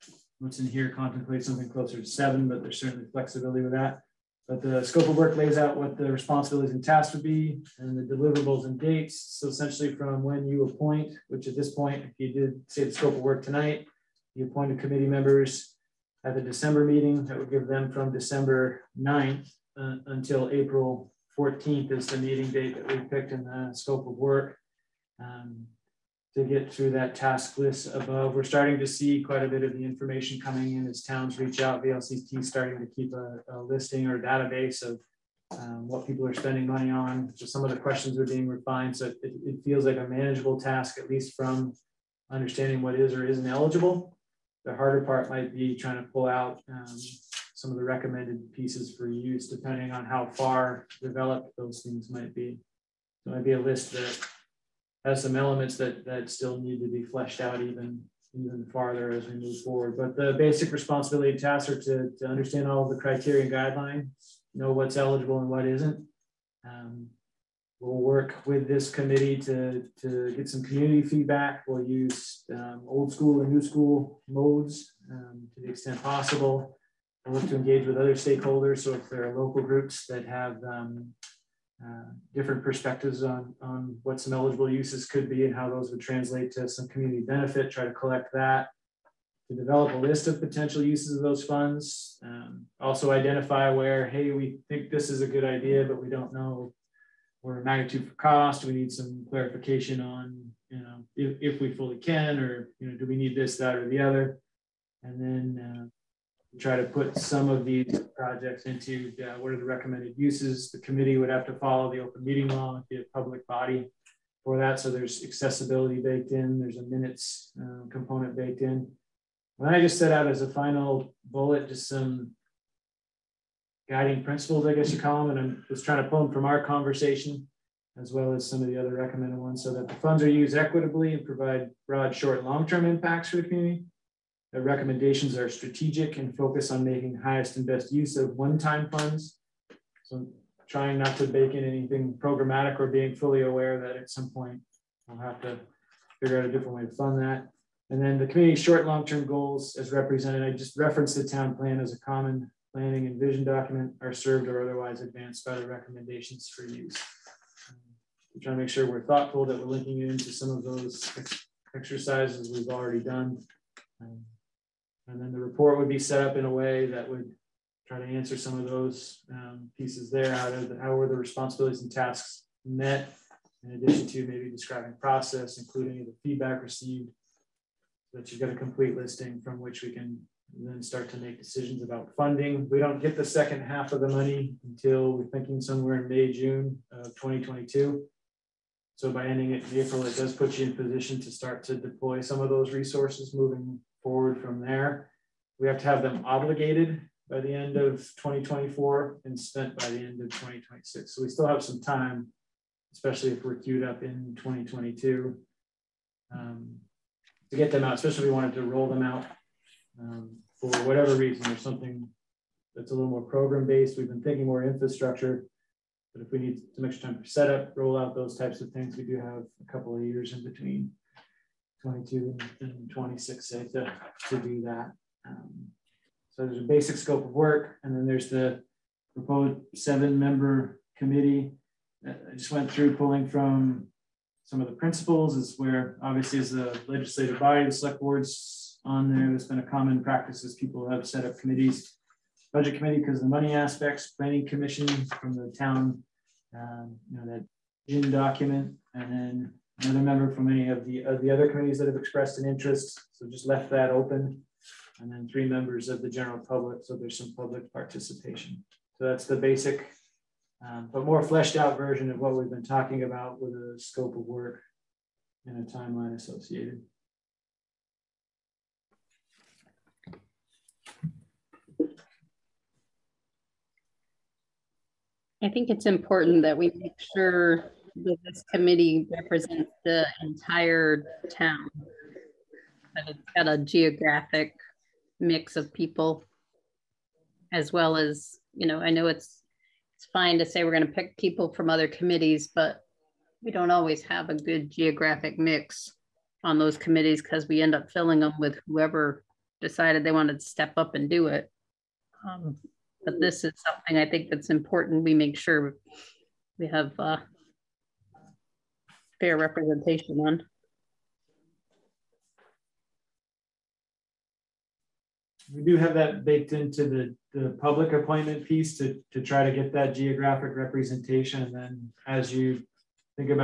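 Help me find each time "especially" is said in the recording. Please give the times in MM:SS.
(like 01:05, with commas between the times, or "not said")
03:22, 03:27.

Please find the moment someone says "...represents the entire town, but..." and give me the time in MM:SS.
04:39.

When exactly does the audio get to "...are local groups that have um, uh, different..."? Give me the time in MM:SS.
01:19.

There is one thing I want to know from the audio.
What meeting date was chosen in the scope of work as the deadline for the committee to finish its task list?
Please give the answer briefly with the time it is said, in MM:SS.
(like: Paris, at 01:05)
April 14th, at 00:20.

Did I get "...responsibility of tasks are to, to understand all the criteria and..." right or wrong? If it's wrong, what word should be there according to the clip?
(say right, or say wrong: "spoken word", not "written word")
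right.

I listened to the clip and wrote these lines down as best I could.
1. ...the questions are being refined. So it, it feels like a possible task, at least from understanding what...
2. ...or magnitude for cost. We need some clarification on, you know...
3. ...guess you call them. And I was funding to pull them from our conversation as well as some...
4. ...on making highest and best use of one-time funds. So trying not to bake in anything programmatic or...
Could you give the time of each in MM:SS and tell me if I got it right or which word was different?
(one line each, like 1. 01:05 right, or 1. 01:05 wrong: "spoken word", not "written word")
1. 00:37 wrong: "manageable", not "possible"
2. 01:37 right
3. 02:04 wrong: "trying", not "funding"
4. 02:16 right.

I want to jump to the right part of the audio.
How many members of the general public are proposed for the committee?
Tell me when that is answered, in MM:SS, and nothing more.
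04:15.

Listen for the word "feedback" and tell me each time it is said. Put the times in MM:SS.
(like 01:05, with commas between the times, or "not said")
01:11, 02:56.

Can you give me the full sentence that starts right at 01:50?
The committee would have to follow the open meeting law and be a public body for that.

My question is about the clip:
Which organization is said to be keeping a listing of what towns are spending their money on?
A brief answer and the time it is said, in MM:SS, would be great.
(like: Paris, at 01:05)
VLCT, at 00:31.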